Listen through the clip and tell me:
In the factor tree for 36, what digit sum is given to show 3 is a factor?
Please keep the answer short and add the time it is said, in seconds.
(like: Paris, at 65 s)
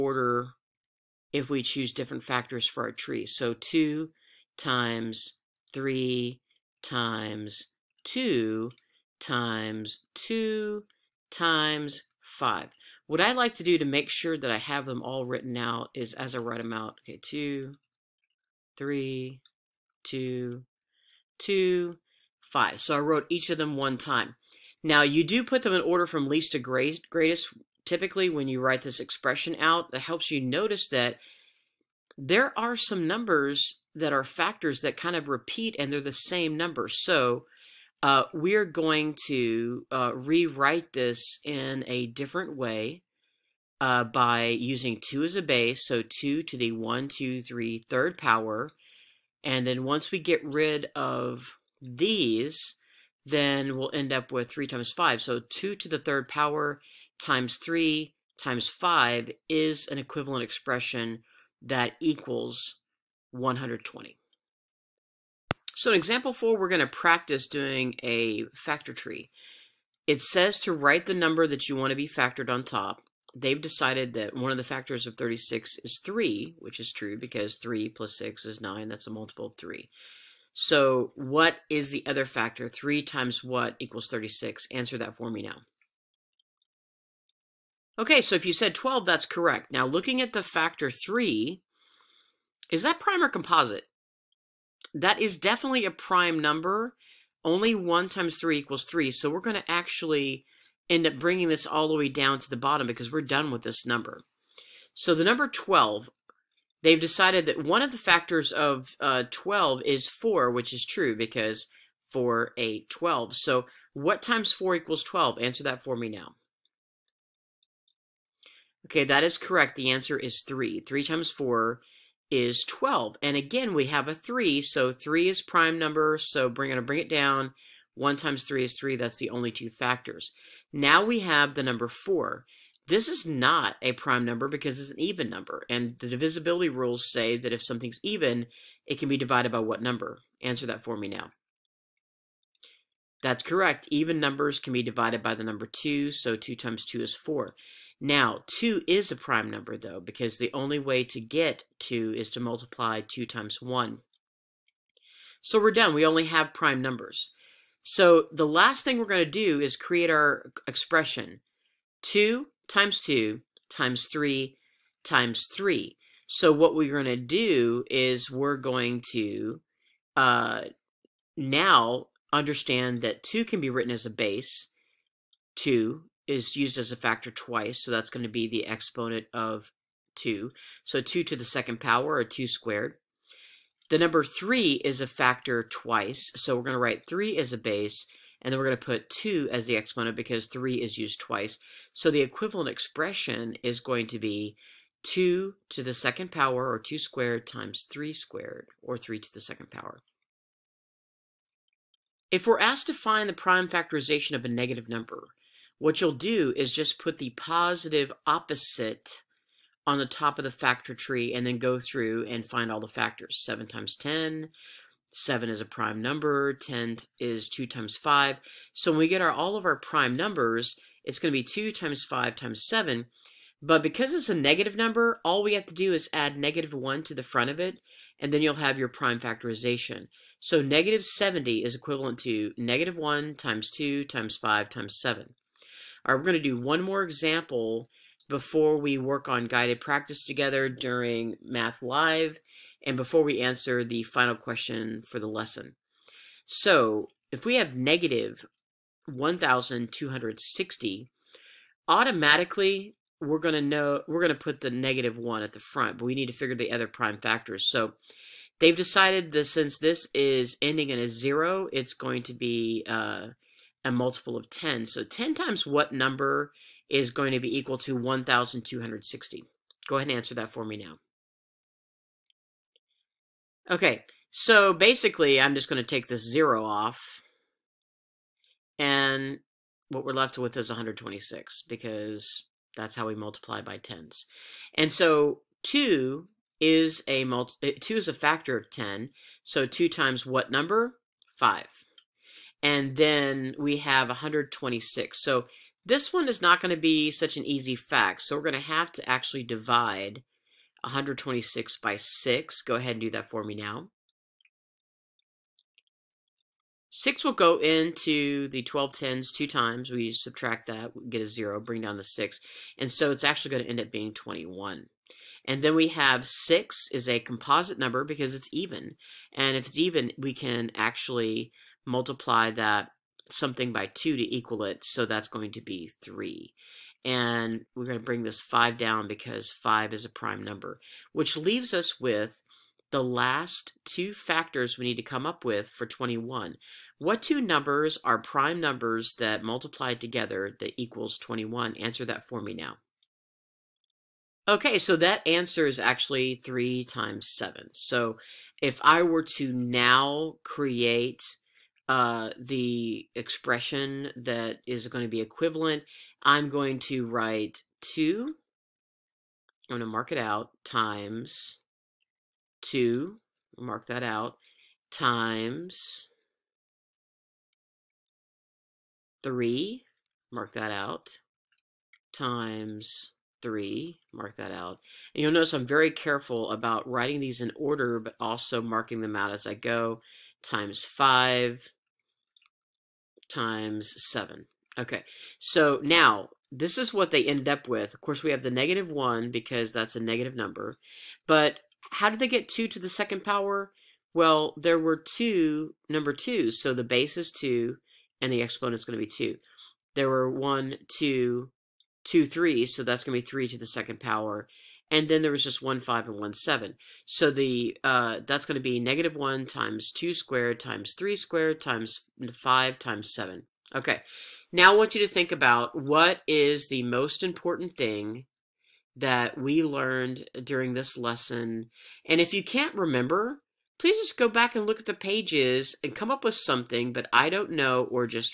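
3 plus 6 is 9, at 77 s.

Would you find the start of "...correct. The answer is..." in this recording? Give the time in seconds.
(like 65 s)
119 s.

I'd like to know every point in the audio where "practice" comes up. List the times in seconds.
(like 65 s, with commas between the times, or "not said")
66 s, 239 s.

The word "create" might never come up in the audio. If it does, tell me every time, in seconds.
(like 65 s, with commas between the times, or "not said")
159 s, 350 s.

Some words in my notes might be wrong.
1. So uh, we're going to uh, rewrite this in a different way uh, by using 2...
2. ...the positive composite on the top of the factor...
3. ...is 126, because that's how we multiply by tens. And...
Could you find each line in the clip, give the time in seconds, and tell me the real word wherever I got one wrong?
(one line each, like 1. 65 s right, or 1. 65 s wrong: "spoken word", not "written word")
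1. 36 s right
2. 207 s wrong: "opposite", not "composite"
3. 280 s right.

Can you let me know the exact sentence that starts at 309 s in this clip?
We subtract that, get a 0, bring down the 6.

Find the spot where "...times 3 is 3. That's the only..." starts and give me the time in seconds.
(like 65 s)
128 s.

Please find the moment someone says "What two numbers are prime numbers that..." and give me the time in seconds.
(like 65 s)
336 s.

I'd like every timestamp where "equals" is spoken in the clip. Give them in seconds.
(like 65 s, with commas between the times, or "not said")
62 s, 83 s, 98 s, 114 s, 267 s, 324 s, 340 s.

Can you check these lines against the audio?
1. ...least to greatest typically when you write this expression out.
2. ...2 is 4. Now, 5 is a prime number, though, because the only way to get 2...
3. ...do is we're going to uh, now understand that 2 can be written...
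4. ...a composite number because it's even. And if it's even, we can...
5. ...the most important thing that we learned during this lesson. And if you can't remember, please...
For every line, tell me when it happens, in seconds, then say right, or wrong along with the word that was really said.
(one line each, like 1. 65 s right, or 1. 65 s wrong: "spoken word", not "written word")
1. 26 s right
2. 146 s wrong: "2", not "5"
3. 167 s right
4. 317 s right
5. 416 s right.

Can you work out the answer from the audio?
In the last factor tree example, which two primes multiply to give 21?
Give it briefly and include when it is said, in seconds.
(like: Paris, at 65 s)
3 times 7, at 346 s.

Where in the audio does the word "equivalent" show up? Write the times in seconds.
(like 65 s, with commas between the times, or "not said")
59 s, 192 s, 231 s, 355 s.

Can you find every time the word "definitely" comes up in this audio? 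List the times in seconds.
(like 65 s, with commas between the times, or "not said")
95 s.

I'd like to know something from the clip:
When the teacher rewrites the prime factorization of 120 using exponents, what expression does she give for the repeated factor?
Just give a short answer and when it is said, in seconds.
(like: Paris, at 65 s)
2 to the third power, at 55 s.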